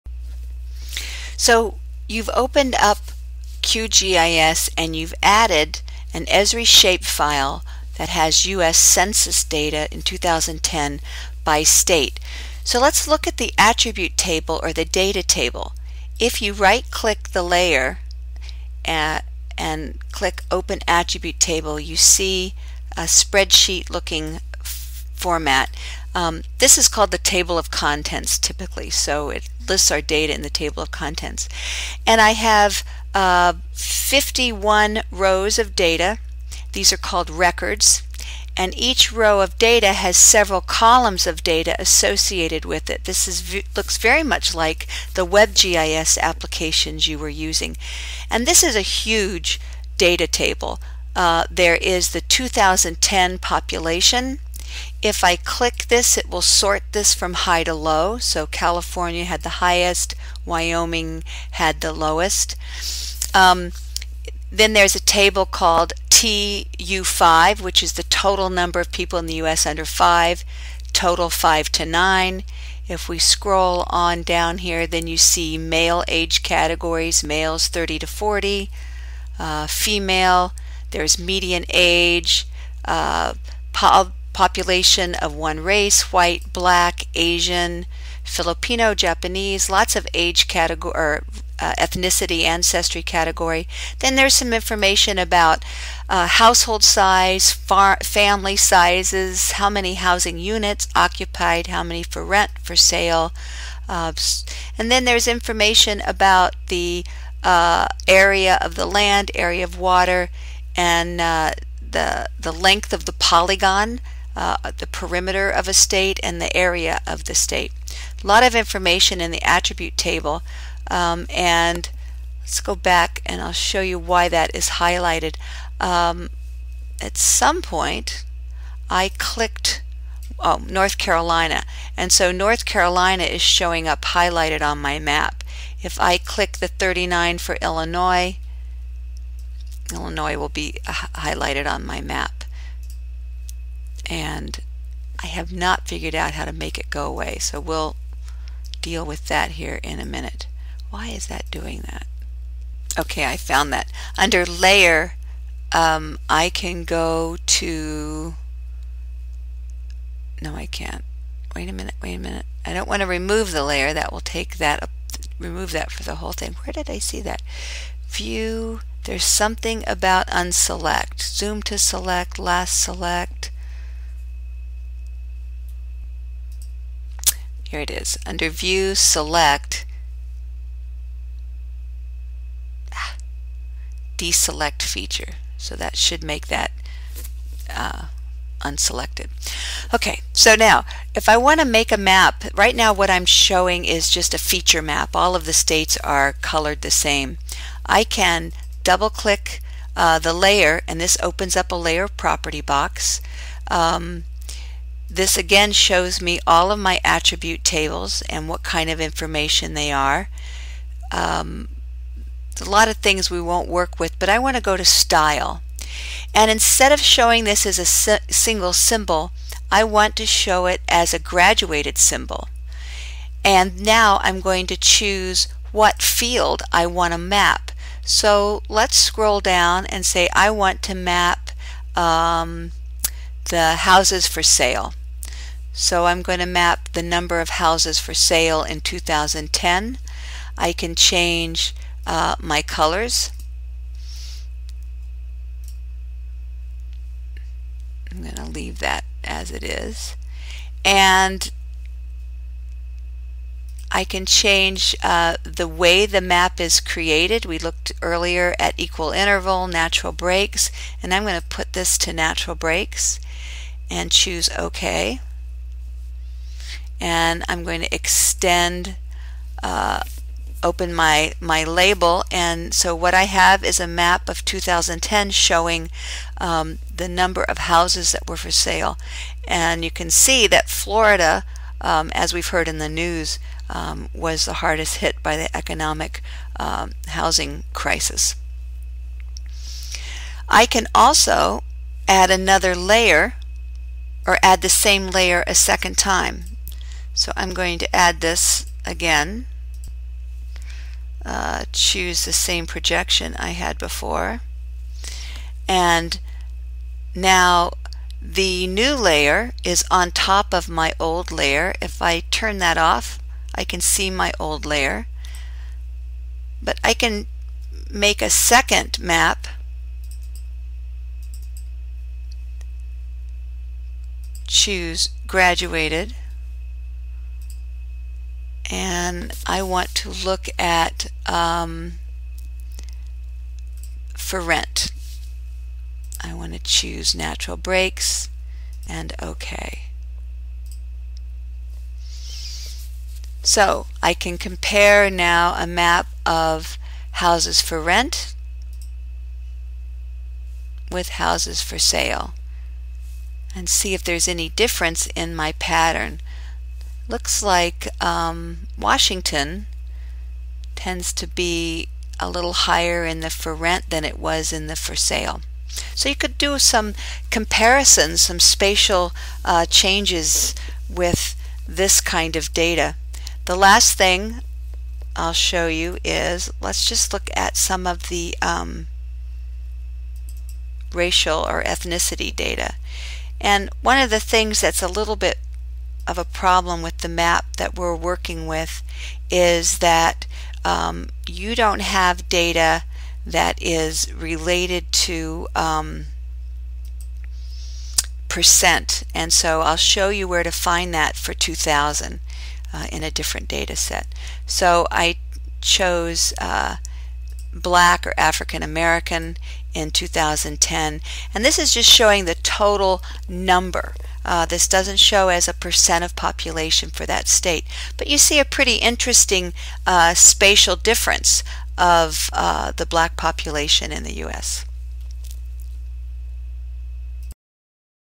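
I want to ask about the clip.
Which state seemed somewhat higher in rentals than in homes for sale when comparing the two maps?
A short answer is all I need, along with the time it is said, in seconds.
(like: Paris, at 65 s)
Washington, at 358 s.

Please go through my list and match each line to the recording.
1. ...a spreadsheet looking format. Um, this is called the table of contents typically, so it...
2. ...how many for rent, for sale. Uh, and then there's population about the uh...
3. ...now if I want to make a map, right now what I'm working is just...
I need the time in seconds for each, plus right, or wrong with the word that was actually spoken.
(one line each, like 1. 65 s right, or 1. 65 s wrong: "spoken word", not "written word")
1. 22 s right
2. 101 s wrong: "information", not "population"
3. 190 s wrong: "showing", not "working".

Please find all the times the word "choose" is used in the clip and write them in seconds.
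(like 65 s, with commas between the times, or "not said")
224 s, 264 s, 301 s, 324 s, 336 s.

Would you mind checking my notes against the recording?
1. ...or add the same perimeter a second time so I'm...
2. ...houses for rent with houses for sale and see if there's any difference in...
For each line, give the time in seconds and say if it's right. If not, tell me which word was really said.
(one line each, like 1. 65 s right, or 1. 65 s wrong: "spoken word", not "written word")
1. 294 s wrong: "layer", not "perimeter"
2. 347 s right.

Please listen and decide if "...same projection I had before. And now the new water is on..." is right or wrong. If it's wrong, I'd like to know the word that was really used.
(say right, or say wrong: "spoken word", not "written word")
wrong: "layer", not "water".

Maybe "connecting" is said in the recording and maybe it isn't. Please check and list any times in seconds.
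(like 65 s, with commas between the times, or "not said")
not said.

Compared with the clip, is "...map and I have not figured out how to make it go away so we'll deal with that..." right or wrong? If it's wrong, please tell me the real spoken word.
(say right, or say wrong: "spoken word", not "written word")
right.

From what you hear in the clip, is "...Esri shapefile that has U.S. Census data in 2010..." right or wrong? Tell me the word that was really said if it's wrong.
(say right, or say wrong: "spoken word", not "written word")
right.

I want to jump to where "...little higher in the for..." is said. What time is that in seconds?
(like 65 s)
362 s.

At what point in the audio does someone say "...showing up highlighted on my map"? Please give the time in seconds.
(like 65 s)
133 s.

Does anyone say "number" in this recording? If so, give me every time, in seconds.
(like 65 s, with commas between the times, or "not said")
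68 s, 237 s, 277 s, 413 s.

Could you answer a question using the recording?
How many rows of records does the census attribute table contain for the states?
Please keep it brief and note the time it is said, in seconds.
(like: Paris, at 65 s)
51, at 33 s.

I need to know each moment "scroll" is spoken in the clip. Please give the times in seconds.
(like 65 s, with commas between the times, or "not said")
73 s, 228 s.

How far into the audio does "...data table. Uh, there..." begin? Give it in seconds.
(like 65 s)
49 s.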